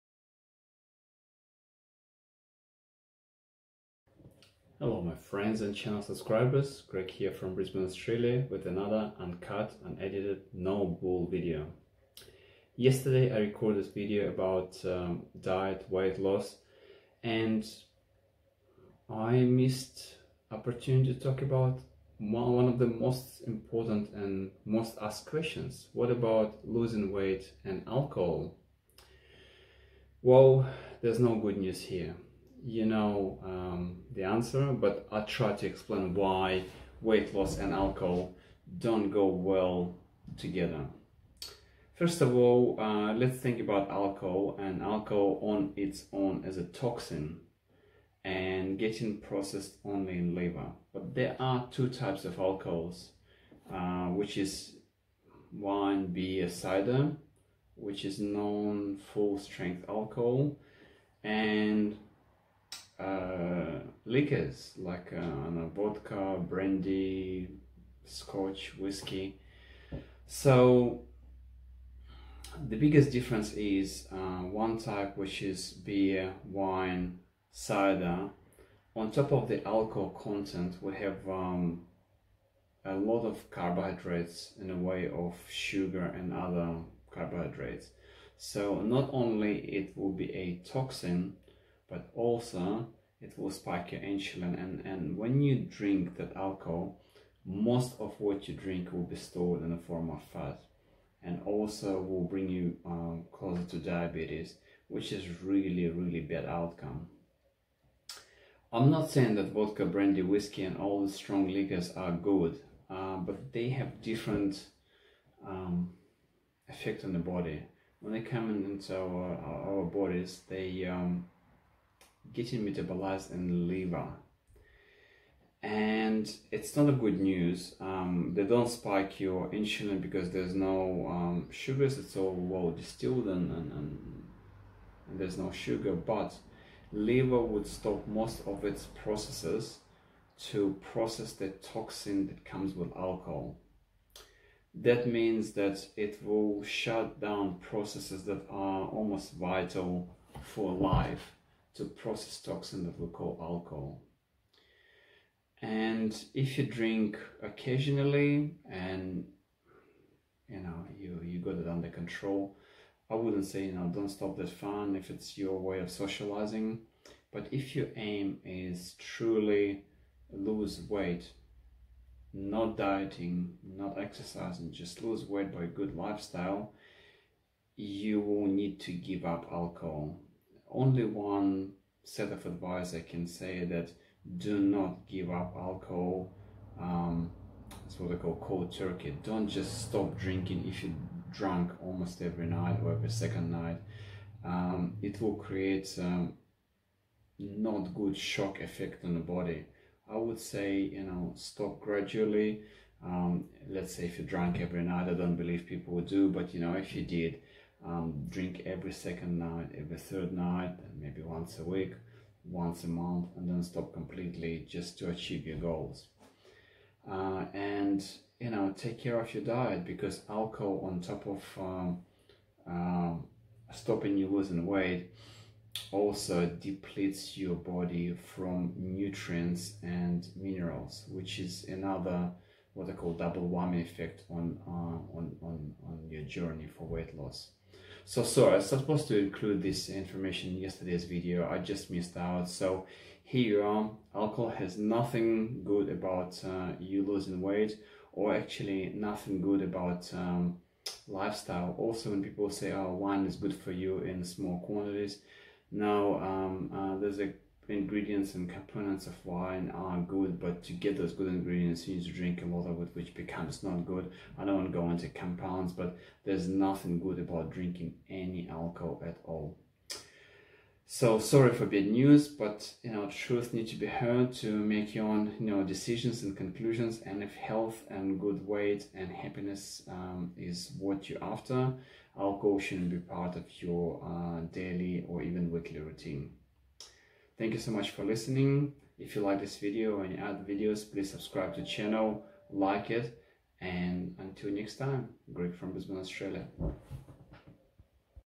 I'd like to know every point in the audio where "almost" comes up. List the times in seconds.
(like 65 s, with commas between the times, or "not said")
148 s, 191 s.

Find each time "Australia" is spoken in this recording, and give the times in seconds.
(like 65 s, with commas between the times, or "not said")
7 s, 295 s.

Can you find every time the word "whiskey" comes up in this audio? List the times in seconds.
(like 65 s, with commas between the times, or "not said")
68 s, 110 s.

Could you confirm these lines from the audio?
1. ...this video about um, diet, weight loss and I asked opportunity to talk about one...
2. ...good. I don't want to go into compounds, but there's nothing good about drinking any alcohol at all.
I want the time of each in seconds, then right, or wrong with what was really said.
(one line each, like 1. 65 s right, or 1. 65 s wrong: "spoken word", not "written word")
1. 13 s wrong: "missed", not "asked"
2. 263 s right.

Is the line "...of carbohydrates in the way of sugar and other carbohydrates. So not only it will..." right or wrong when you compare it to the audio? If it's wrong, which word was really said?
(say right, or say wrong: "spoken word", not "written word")
right.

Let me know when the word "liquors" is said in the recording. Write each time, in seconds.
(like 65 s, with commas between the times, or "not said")
64 s, 111 s.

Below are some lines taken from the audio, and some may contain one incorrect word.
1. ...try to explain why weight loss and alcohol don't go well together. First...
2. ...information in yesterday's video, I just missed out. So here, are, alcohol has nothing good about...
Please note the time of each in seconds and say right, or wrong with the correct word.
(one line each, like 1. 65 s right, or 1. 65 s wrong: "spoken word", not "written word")
1. 35 s right
2. 239 s right.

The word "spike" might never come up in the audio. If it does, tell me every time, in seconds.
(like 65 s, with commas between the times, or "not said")
93 s, 128 s.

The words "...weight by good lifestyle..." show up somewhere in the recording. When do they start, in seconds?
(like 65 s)
175 s.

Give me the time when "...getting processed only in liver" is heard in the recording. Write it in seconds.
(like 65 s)
48 s.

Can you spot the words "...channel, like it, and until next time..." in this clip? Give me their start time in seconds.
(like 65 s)
291 s.